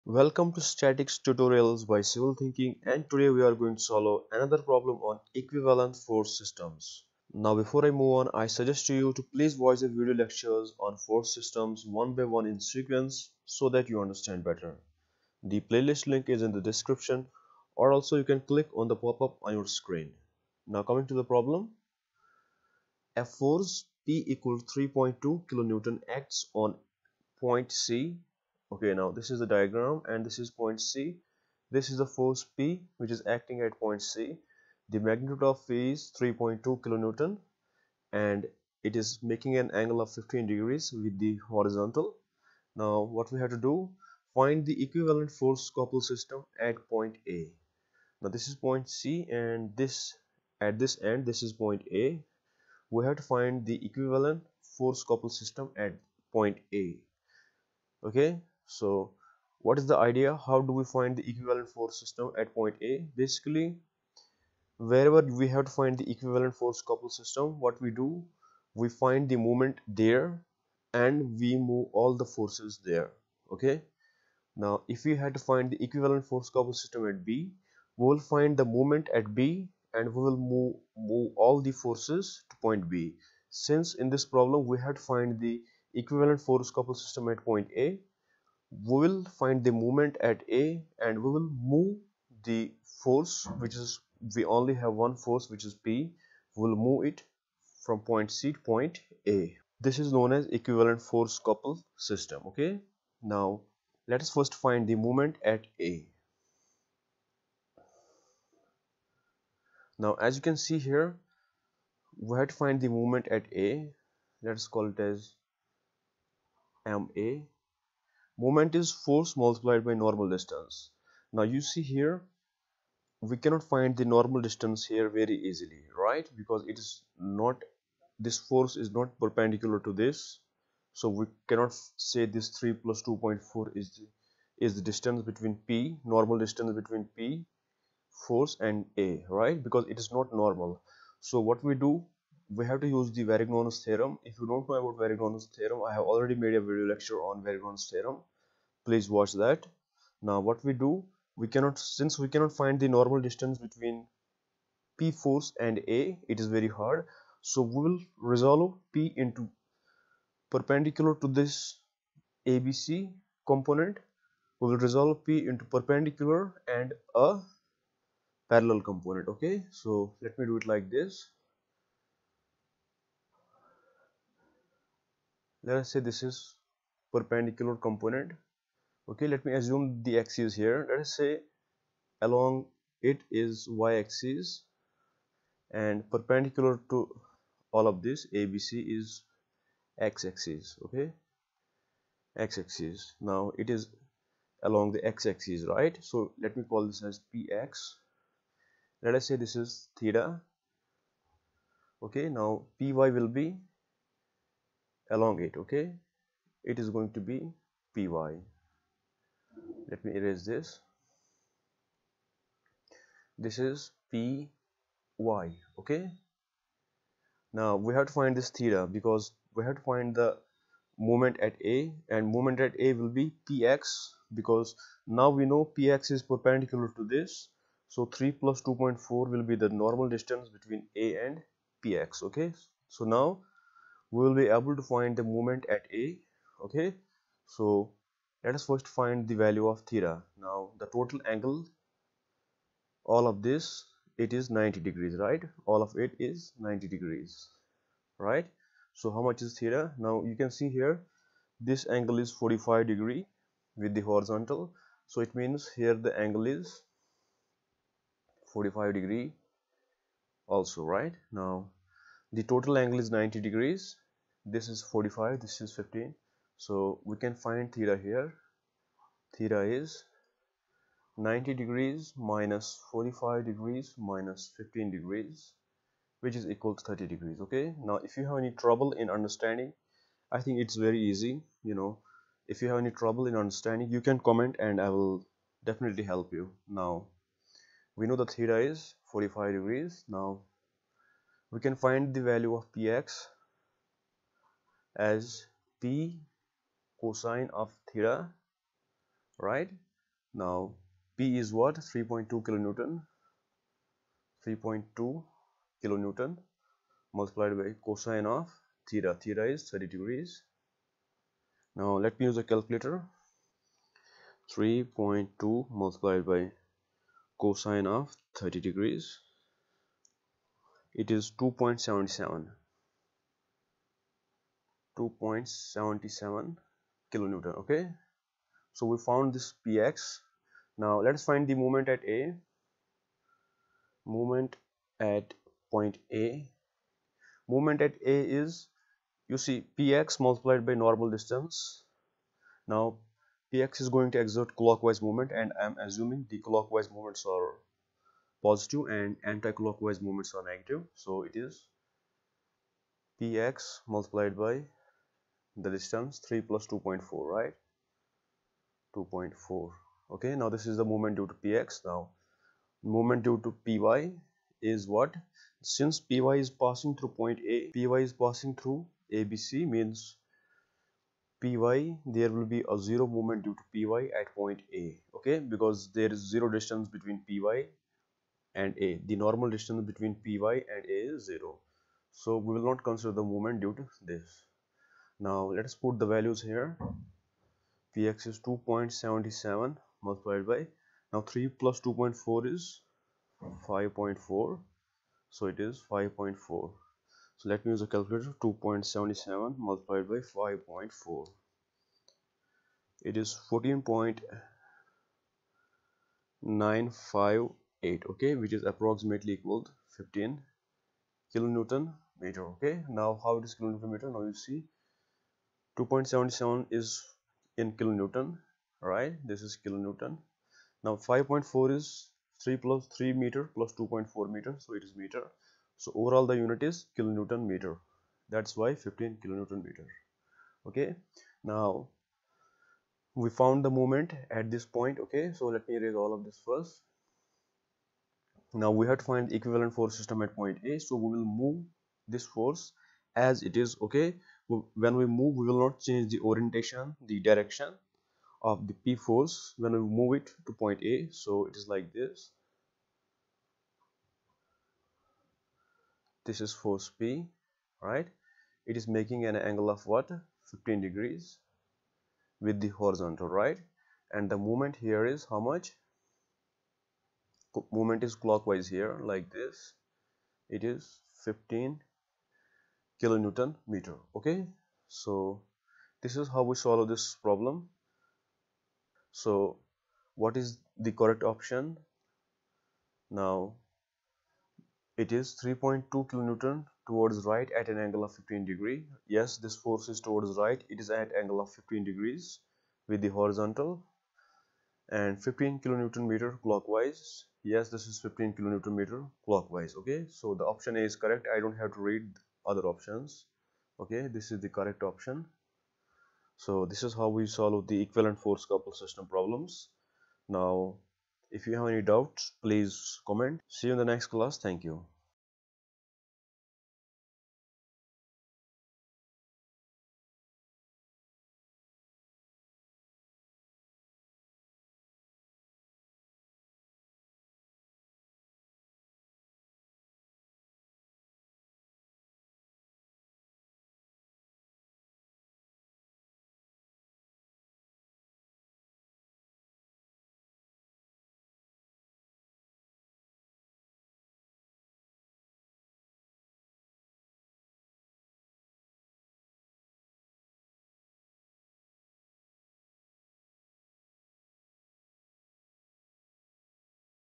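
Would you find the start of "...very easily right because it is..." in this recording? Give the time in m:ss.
2:05.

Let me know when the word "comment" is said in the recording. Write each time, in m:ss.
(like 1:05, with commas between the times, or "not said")
4:44, 8:33.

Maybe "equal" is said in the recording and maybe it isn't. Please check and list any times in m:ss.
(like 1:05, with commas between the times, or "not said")
0:24, 4:36, 6:49.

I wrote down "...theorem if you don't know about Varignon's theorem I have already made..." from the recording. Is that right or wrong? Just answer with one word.
right.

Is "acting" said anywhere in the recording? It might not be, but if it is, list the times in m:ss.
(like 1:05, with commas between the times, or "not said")
0:33.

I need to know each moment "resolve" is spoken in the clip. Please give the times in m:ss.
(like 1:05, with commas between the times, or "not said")
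2:38, 2:44.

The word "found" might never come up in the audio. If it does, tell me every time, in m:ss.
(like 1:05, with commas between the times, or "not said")
5:29, 7:13.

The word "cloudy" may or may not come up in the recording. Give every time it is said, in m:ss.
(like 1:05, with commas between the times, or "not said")
not said.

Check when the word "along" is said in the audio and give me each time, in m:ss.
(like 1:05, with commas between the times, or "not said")
3:02, 3:14, 3:25.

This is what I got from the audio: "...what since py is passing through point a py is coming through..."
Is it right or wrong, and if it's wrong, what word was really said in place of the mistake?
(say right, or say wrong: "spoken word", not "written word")
wrong: "passing", not "coming".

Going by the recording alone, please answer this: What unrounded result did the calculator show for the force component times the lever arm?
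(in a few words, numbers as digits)
14.958.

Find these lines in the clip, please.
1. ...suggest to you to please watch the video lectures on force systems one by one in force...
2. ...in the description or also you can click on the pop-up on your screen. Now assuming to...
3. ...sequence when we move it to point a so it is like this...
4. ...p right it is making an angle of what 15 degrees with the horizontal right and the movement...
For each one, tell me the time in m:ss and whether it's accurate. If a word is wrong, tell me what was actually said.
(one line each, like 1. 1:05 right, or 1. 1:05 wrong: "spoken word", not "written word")
1. 0:08 wrong: "sequence", not "force"
2. 0:16 wrong: "coming", not "assuming"
3. 7:28 wrong: "force", not "sequence"
4. 7:36 right.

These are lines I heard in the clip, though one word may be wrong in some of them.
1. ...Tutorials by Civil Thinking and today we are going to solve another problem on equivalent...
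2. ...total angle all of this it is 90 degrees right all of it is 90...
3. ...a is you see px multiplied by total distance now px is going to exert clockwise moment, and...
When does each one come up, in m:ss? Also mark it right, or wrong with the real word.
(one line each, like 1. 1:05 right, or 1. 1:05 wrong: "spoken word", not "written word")
1. 0:01 right
2. 4:00 right
3. 5:38 wrong: "normal", not "total".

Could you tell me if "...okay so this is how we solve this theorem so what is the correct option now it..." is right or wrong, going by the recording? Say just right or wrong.
wrong.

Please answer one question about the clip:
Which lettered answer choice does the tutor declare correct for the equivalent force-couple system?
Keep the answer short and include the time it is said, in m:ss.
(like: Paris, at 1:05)
option A, at 8:20.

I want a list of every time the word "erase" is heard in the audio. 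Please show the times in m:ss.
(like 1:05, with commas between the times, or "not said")
3:30, 7:15.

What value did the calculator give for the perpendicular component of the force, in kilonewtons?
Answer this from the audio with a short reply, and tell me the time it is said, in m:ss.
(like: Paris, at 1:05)
2.77, at 5:25.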